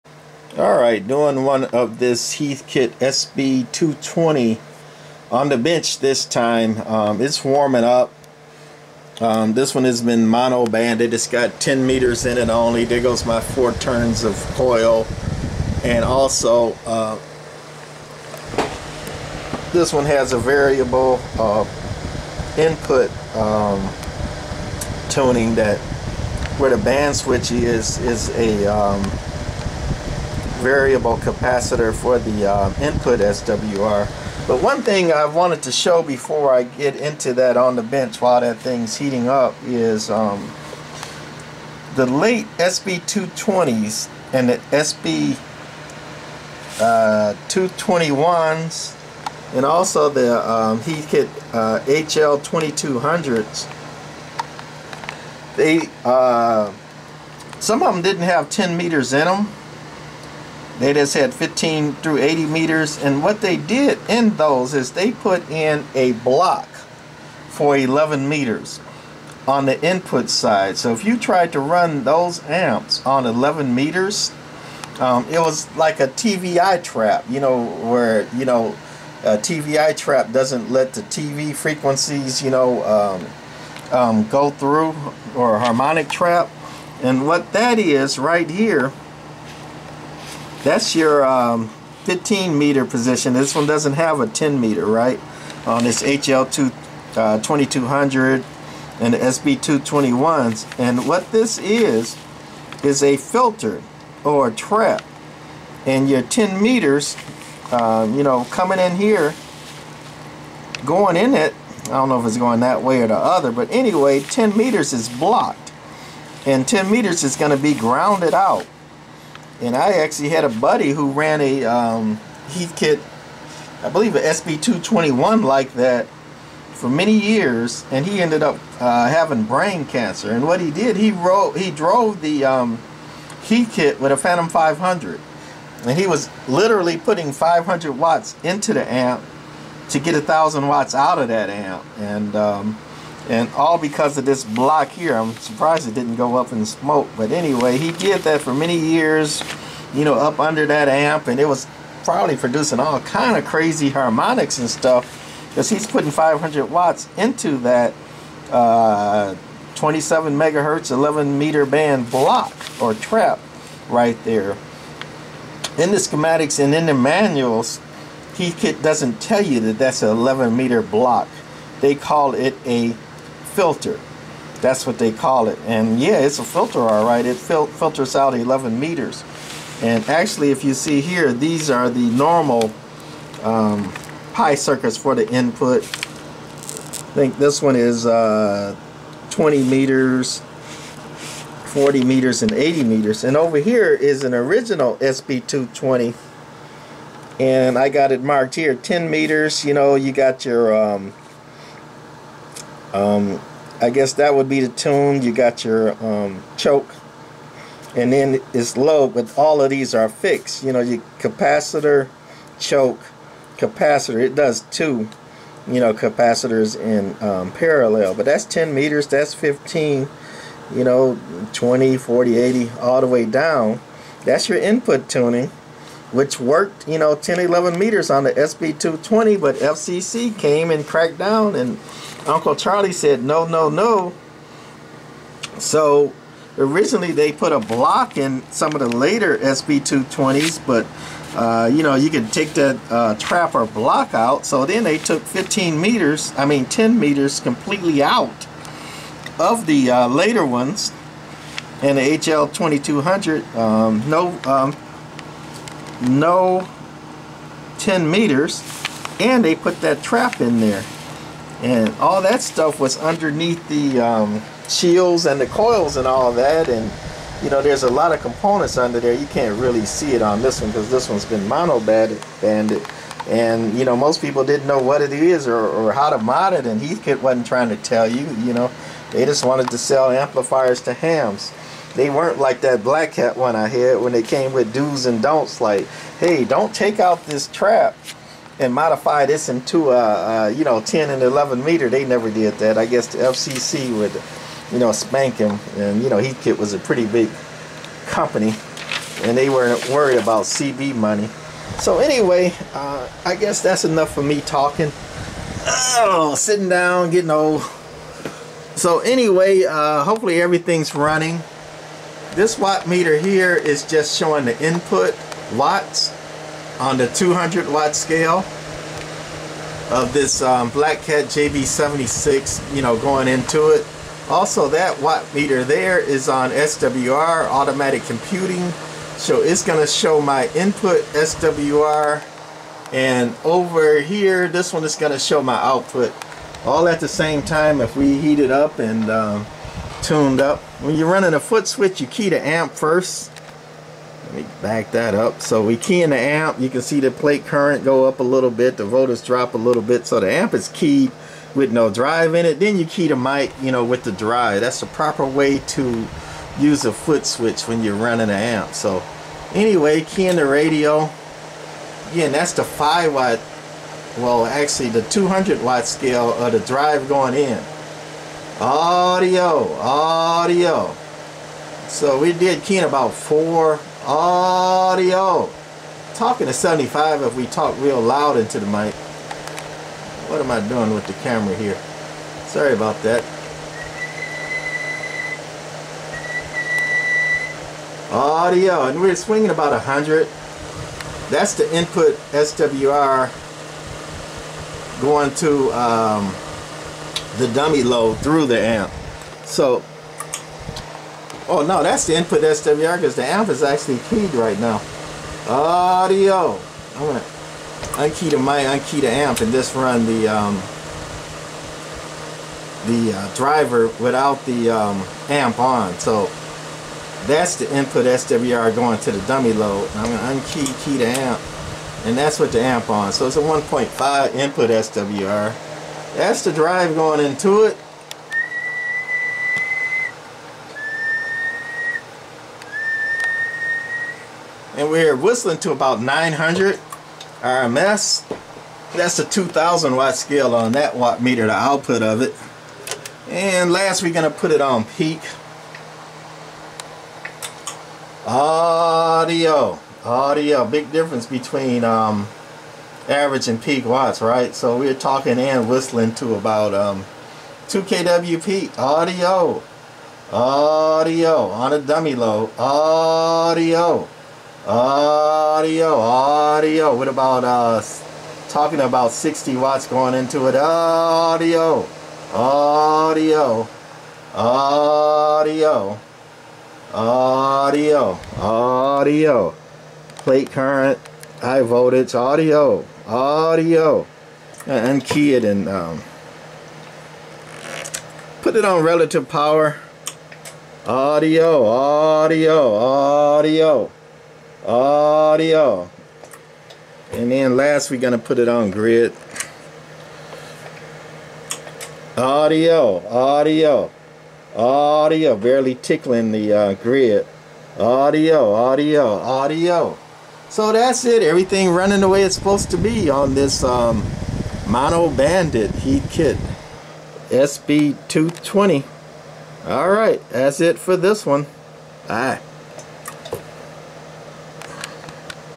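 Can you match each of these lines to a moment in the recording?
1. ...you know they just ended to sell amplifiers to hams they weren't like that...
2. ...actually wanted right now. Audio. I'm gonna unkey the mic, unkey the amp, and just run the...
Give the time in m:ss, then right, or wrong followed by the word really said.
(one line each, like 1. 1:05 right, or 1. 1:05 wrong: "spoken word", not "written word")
1. 4:38 wrong: "wanted", not "ended"
2. 6:43 wrong: "keyed", not "wanted".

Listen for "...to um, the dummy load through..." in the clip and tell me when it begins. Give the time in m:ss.
6:35.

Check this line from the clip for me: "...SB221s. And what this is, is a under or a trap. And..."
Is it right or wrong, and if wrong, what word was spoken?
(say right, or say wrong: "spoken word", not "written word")
wrong: "filter", not "under".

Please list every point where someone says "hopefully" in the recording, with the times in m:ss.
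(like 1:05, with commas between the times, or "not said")
5:10.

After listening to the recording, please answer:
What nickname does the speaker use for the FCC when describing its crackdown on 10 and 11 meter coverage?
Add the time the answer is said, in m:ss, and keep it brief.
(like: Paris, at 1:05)
Uncle Charlie, at 3:52.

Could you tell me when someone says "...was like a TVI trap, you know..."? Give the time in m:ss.
1:15.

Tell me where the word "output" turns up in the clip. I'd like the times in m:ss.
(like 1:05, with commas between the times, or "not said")
5:35, 7:21.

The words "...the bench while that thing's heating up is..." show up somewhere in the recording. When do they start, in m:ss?
0:37.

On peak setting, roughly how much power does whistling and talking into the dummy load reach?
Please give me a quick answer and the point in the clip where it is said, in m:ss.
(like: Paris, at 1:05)
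2 kW, at 7:37.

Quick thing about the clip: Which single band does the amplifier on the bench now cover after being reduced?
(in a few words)
10 meters.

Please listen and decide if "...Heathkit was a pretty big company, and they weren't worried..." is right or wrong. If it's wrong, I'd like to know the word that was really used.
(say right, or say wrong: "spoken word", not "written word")
right.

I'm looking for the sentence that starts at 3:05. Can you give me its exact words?
I think this one is uh, 20 meters, 40 meters, and 80 meters.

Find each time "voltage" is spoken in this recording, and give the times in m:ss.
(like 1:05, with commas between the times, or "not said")
5:48, 8:01.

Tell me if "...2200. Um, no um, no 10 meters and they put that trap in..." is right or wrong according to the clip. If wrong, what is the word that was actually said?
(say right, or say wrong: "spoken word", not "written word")
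right.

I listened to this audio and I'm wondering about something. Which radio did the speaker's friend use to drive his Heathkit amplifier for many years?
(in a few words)
Phantom 500.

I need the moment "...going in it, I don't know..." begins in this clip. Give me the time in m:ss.
1:50.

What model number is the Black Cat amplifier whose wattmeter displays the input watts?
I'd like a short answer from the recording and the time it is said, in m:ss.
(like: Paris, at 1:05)
JB76, at 5:21.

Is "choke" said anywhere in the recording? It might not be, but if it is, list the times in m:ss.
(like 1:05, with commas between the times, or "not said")
3:26, 3:32.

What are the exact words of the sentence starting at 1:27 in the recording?
And what that is right here that's your um, 15 meter position.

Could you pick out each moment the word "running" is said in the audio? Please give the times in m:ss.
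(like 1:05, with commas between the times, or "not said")
5:10, 5:41, 5:57, 8:31.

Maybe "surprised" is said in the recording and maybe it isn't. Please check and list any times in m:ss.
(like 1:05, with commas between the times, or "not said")
2:25.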